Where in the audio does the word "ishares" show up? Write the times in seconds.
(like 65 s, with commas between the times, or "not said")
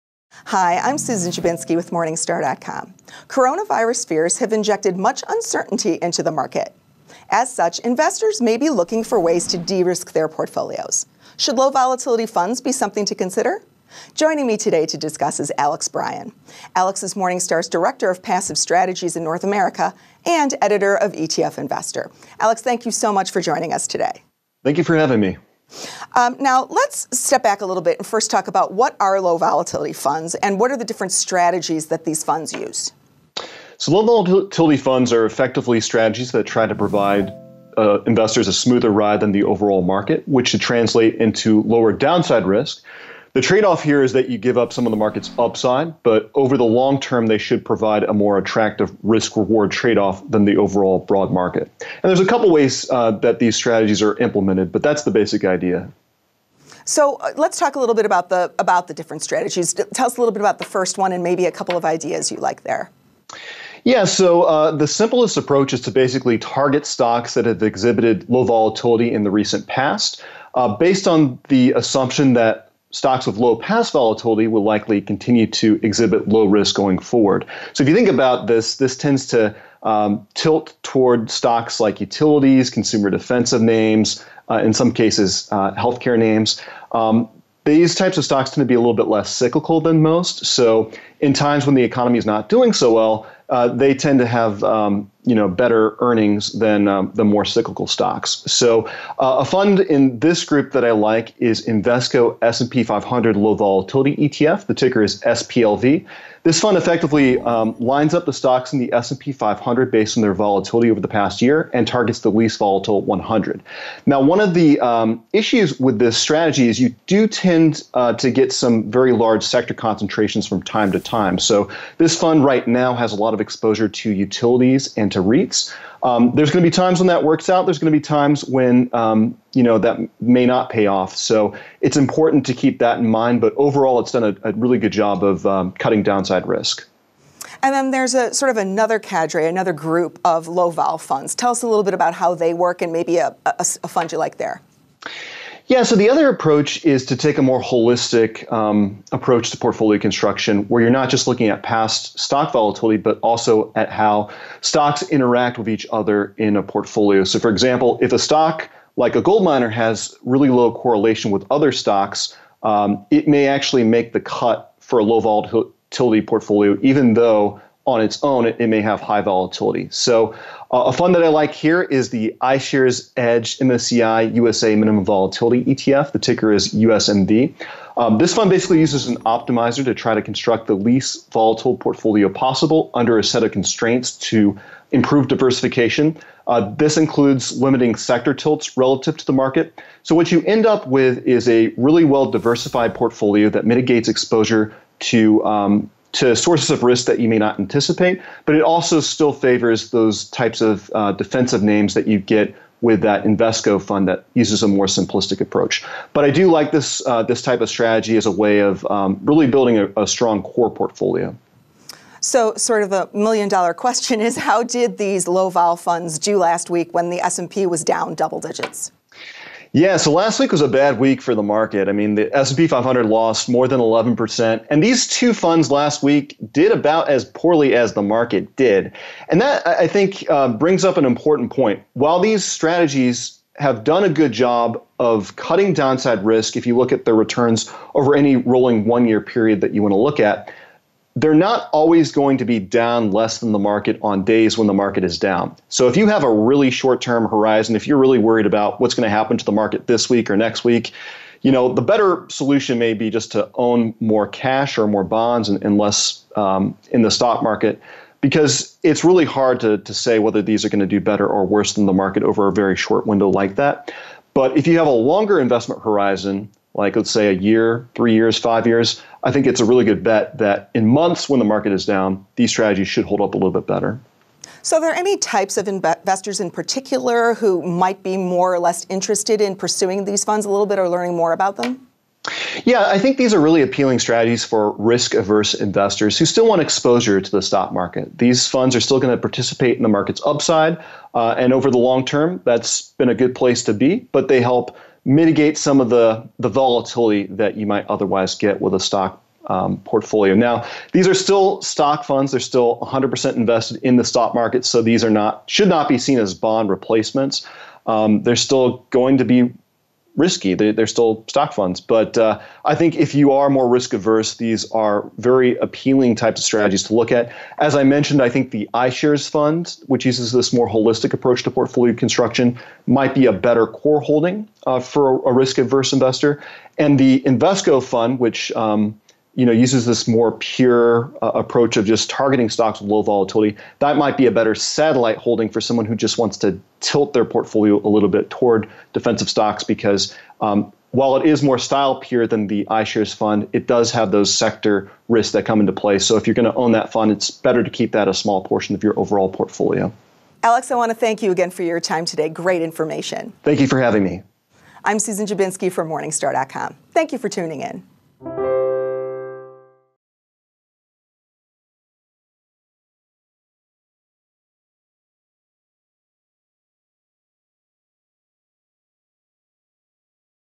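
172 s, 318 s, 342 s.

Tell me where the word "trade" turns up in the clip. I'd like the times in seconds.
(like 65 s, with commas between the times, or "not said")
43 s, 49 s.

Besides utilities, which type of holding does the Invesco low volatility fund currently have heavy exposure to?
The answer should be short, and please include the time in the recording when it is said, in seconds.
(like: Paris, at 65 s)
REITs, at 125 s.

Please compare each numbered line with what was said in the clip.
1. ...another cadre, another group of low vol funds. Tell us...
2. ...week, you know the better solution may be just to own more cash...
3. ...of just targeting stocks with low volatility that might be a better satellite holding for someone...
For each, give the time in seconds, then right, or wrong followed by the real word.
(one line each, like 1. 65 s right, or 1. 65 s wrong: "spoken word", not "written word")
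1. 138 s right
2. 250 s right
3. 331 s right.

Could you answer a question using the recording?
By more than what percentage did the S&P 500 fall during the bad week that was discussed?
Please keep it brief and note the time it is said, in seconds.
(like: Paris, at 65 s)
11%, at 223 s.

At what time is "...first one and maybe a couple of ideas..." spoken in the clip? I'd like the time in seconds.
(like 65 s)
60 s.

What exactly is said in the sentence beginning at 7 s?
As such, investors may be looking for ways to de risk their portfolios.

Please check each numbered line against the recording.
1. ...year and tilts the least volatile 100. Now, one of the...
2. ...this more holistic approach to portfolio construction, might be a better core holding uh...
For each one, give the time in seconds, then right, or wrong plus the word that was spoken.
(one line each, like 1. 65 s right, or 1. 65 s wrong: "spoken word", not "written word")
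1. 111 s wrong: "targets", not "tilts"
2. 320 s right.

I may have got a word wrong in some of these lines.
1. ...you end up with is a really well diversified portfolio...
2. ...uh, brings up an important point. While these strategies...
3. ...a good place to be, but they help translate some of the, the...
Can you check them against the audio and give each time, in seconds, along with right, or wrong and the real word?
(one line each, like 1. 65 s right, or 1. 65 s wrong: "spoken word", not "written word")
1. 190 s right
2. 230 s right
3. 293 s wrong: "mitigate", not "translate".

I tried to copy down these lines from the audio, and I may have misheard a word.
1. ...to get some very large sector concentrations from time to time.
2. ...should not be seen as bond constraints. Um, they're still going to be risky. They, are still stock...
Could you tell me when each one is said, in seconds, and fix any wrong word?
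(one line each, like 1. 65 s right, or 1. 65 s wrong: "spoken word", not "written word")
1. 118 s right
2. 305 s wrong: "replacements", not "constraints".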